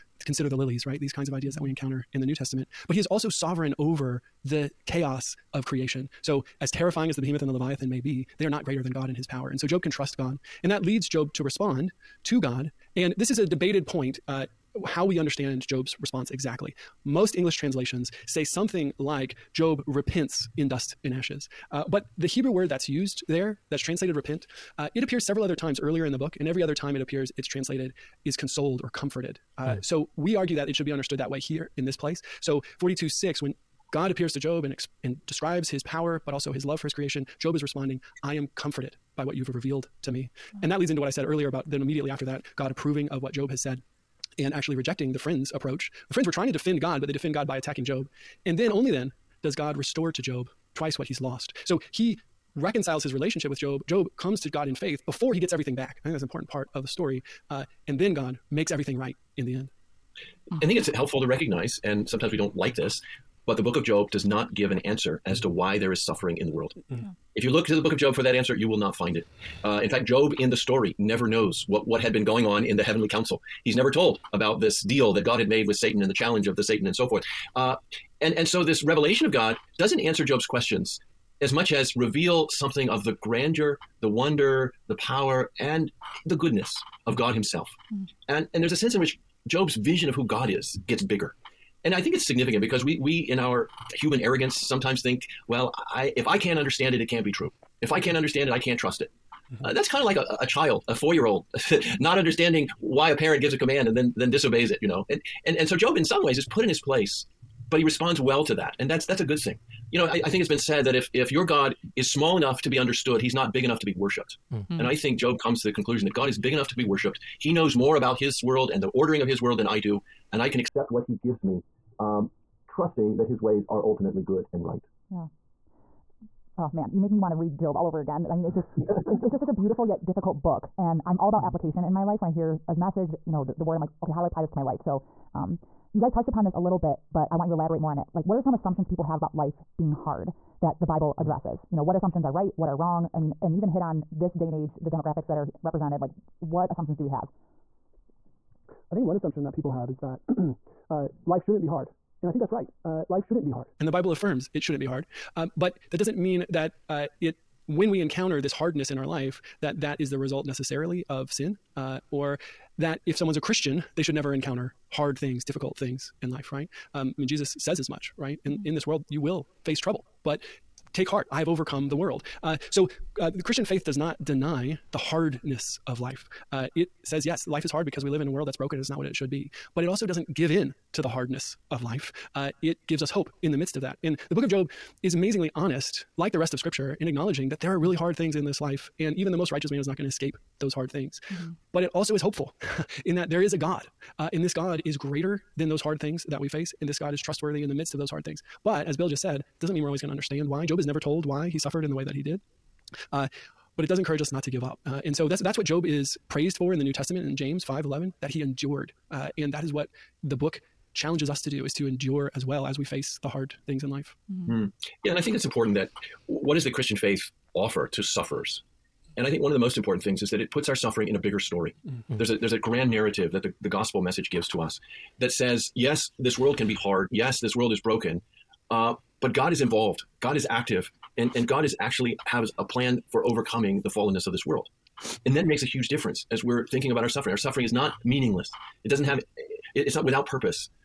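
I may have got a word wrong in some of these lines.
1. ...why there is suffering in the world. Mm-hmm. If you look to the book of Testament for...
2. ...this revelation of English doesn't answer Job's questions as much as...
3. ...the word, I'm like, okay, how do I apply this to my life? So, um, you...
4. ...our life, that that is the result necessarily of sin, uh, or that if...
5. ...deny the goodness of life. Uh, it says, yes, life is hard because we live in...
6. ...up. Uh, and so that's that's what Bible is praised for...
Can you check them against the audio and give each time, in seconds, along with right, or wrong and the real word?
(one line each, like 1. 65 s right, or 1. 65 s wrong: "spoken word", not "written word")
1. 65 s wrong: "Job", not "Testament"
2. 78 s wrong: "God", not "English"
3. 133 s right
4. 158 s right
5. 174 s wrong: "hardness", not "goodness"
6. 204 s wrong: "Job", not "Bible".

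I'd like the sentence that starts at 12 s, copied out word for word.
And this is a debated point.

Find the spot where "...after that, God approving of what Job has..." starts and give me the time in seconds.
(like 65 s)
42 s.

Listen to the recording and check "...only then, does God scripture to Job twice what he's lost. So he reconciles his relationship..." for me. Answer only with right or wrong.
wrong.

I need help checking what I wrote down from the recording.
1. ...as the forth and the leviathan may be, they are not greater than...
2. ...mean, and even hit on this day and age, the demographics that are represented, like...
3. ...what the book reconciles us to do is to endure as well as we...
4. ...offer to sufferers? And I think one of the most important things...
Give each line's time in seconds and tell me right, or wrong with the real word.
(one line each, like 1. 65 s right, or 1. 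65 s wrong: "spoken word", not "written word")
1. 7 s wrong: "behemoth", not "forth"
2. 143 s right
3. 209 s wrong: "challenges", not "reconciles"
4. 217 s right.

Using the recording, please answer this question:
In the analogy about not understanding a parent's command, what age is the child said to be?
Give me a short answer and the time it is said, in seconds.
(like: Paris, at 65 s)
4, at 100 s.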